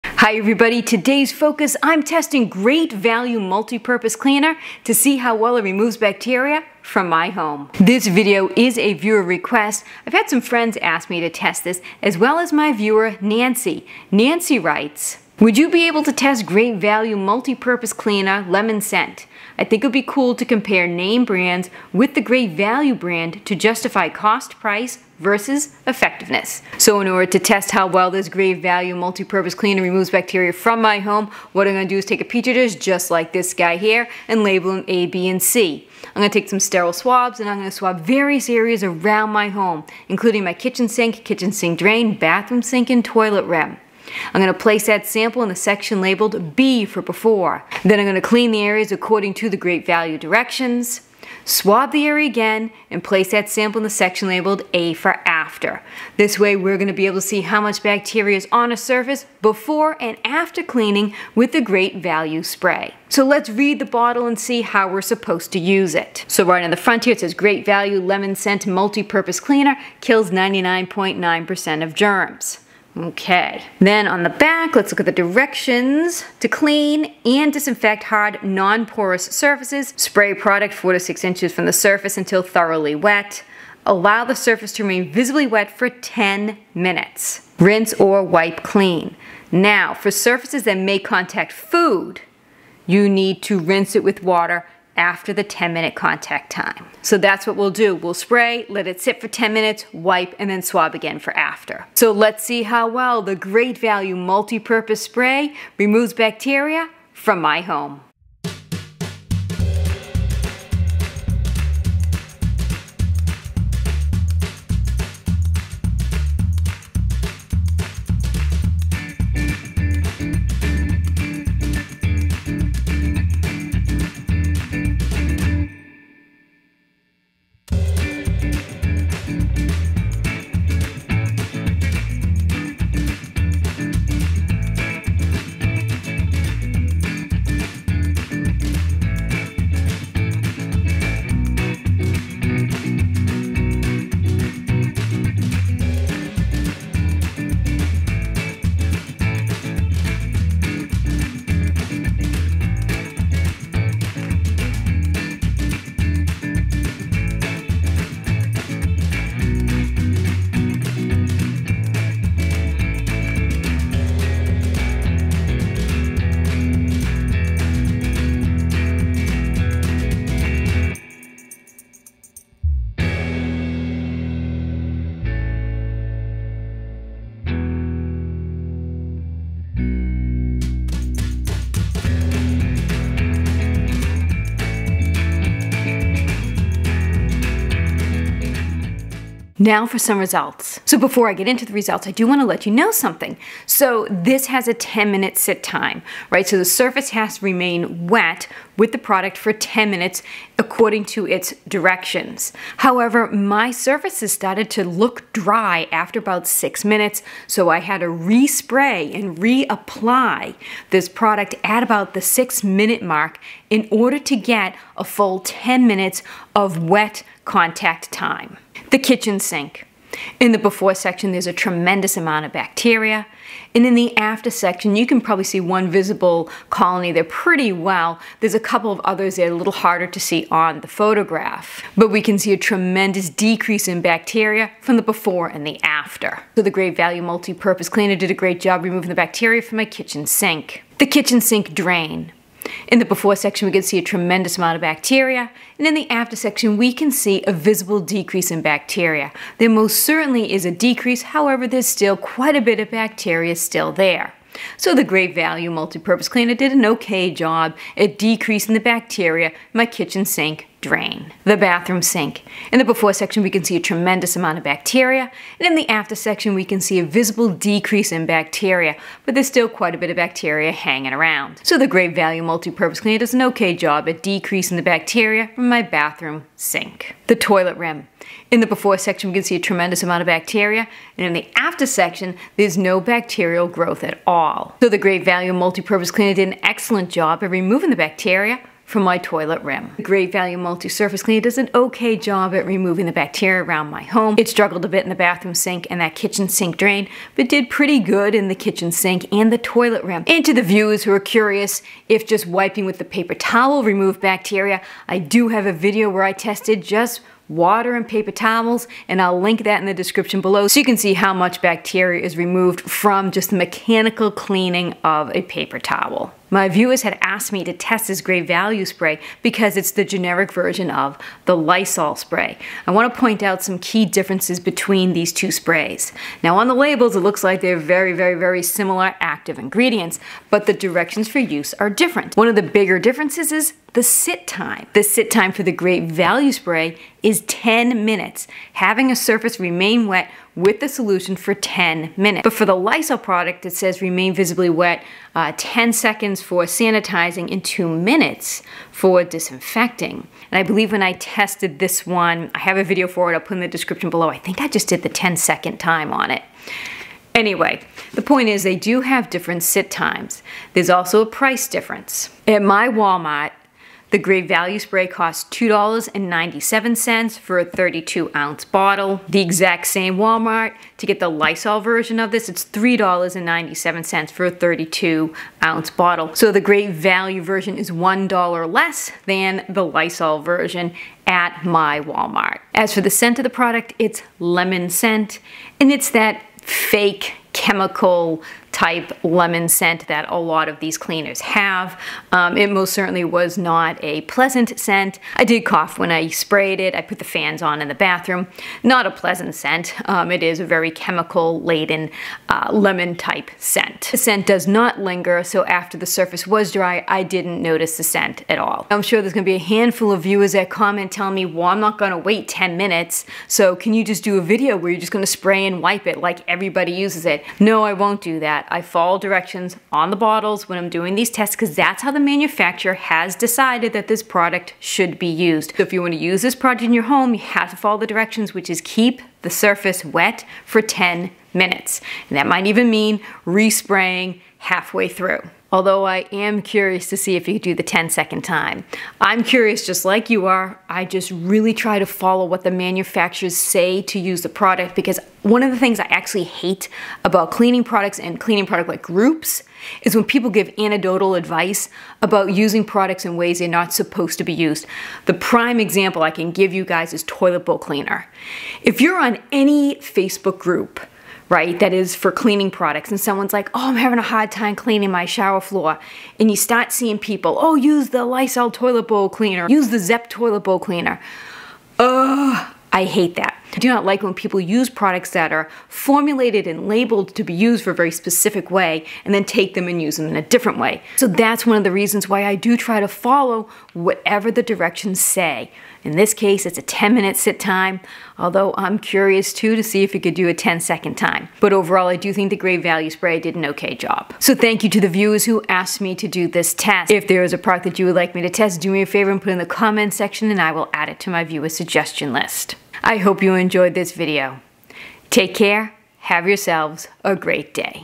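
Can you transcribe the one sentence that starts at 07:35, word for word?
The prime example I can give you guys is toilet bowl cleaner.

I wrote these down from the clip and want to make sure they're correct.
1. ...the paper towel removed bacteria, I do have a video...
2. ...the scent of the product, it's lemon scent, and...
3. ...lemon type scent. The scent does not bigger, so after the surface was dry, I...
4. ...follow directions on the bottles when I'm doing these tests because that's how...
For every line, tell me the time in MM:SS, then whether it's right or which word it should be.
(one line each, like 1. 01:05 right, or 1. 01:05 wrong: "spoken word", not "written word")
1. 05:02 right
2. 06:22 right
3. 06:42 wrong: "linger", not "bigger"
4. 06:58 right.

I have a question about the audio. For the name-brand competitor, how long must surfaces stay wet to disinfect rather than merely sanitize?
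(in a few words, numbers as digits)
2 minutes.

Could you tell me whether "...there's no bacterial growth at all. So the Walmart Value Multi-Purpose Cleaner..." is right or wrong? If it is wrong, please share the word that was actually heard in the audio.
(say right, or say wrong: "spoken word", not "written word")
wrong: "Great", not "Walmart".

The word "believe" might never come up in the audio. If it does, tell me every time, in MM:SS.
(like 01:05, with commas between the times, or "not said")
05:50.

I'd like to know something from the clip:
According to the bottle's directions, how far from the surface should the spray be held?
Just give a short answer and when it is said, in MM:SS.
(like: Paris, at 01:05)
4 to 6 inches, at 01:20.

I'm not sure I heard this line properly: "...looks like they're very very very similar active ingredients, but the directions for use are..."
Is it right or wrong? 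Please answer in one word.
right.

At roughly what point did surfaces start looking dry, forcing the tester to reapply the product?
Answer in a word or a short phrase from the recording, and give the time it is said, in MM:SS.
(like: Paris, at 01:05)
6 minutes, at 03:26.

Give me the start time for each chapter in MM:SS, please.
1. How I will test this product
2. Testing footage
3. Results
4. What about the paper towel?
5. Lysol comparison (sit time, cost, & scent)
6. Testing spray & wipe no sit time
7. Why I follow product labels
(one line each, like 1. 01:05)
1. 00:26
2. 01:07
3. 03:09
4. 05:00
5. 05:16
6. 06:48
7. 07:15.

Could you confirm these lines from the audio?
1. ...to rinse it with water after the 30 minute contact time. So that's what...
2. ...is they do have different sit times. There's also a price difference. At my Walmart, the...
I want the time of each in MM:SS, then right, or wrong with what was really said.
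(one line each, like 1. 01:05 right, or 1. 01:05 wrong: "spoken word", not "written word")
1. 01:33 wrong: "10", not "30"
2. 05:58 right.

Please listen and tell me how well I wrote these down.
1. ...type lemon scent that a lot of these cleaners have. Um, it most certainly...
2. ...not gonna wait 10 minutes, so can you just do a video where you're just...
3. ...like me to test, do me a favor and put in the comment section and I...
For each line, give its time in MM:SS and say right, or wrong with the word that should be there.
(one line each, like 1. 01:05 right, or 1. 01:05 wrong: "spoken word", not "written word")
1. 06:28 right
2. 06:51 right
3. 08:18 right.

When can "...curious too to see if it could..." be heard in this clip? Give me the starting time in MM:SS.
08:08.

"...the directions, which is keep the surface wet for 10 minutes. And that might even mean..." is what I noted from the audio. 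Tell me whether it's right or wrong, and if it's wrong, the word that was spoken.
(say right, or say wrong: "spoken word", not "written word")
right.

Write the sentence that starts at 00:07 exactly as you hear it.
This video is a viewer request.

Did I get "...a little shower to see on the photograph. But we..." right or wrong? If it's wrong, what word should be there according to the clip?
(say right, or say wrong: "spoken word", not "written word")
wrong: "harder", not "shower".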